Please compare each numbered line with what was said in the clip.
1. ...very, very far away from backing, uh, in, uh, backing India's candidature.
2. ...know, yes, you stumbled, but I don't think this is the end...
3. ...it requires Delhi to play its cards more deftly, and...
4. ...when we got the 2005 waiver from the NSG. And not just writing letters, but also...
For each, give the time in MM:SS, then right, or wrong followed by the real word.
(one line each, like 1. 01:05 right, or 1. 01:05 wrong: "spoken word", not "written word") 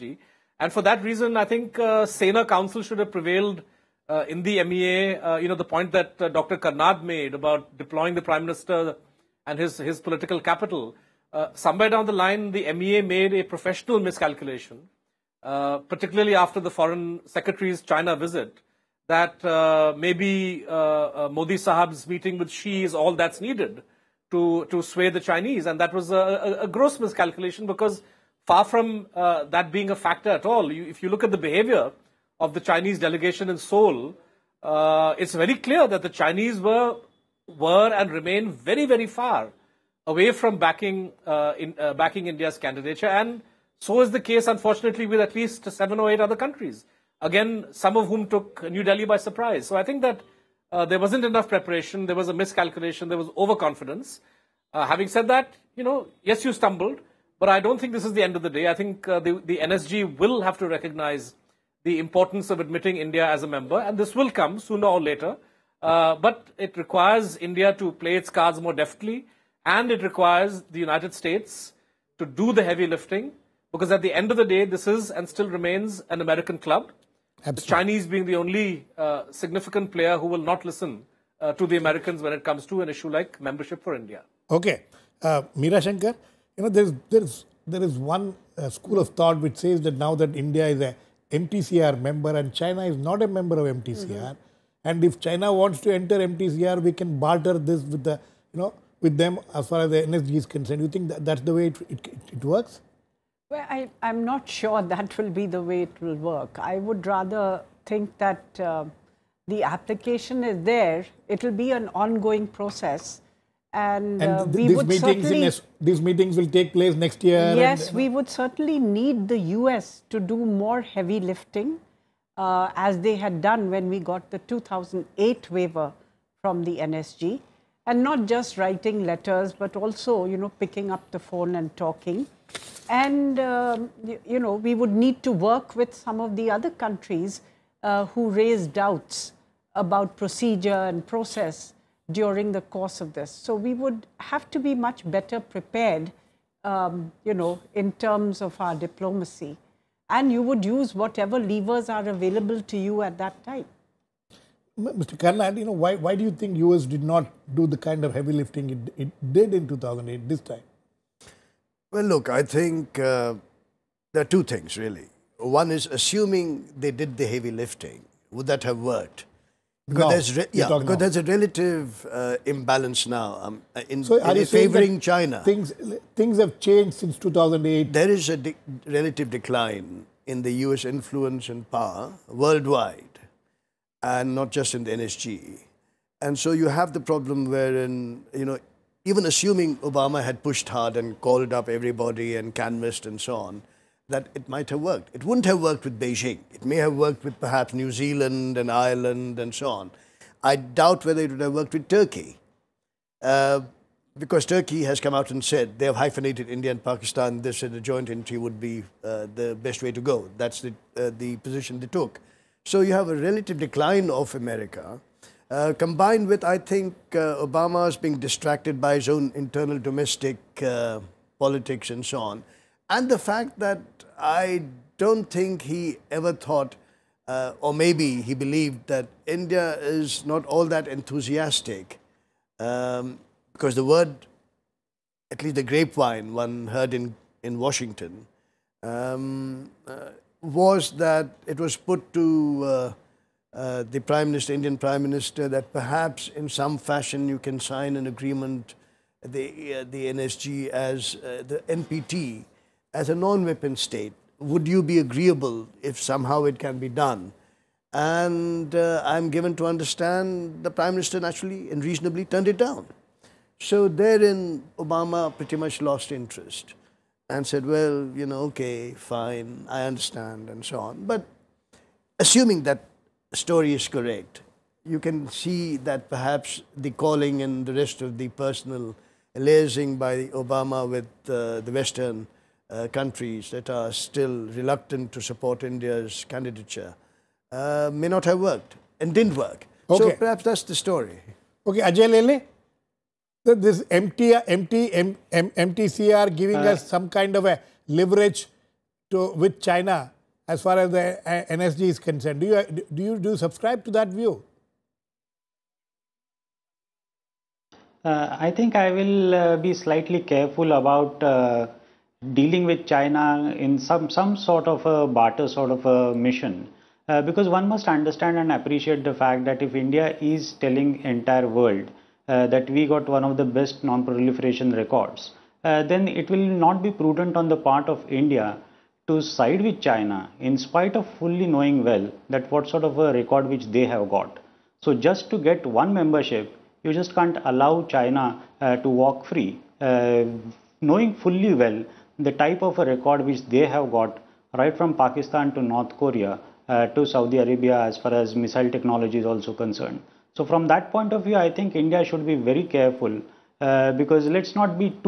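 1. 00:38 right
2. 00:55 right
3. 01:06 wrong: "India", not "Delhi"
4. 02:03 wrong: "2008", not "2005".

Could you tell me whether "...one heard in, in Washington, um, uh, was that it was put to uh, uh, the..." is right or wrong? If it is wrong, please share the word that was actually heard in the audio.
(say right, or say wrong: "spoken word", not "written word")
right.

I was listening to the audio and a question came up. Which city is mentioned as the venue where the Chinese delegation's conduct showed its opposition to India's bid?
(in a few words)
Seoul.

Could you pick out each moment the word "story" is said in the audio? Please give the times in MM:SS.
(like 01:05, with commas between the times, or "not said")
04:33, 04:50.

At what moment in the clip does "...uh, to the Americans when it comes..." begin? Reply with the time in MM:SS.
01:21.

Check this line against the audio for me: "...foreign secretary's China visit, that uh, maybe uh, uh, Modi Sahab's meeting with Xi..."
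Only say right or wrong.
right.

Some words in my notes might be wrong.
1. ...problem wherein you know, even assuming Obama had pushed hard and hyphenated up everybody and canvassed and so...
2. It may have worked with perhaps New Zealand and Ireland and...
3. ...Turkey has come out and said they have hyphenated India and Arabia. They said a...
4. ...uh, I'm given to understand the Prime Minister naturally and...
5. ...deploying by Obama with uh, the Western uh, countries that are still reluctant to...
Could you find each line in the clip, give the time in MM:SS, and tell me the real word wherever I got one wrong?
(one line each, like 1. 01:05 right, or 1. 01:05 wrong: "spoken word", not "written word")
1. 03:07 wrong: "called", not "hyphenated"
2. 03:16 right
3. 03:24 wrong: "Pakistan", not "Arabia"
4. 04:18 right
5. 04:39 wrong: "liaising", not "deploying".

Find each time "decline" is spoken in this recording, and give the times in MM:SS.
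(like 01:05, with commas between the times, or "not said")
02:59, 03:33.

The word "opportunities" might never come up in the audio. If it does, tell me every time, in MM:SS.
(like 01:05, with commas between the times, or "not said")
not said.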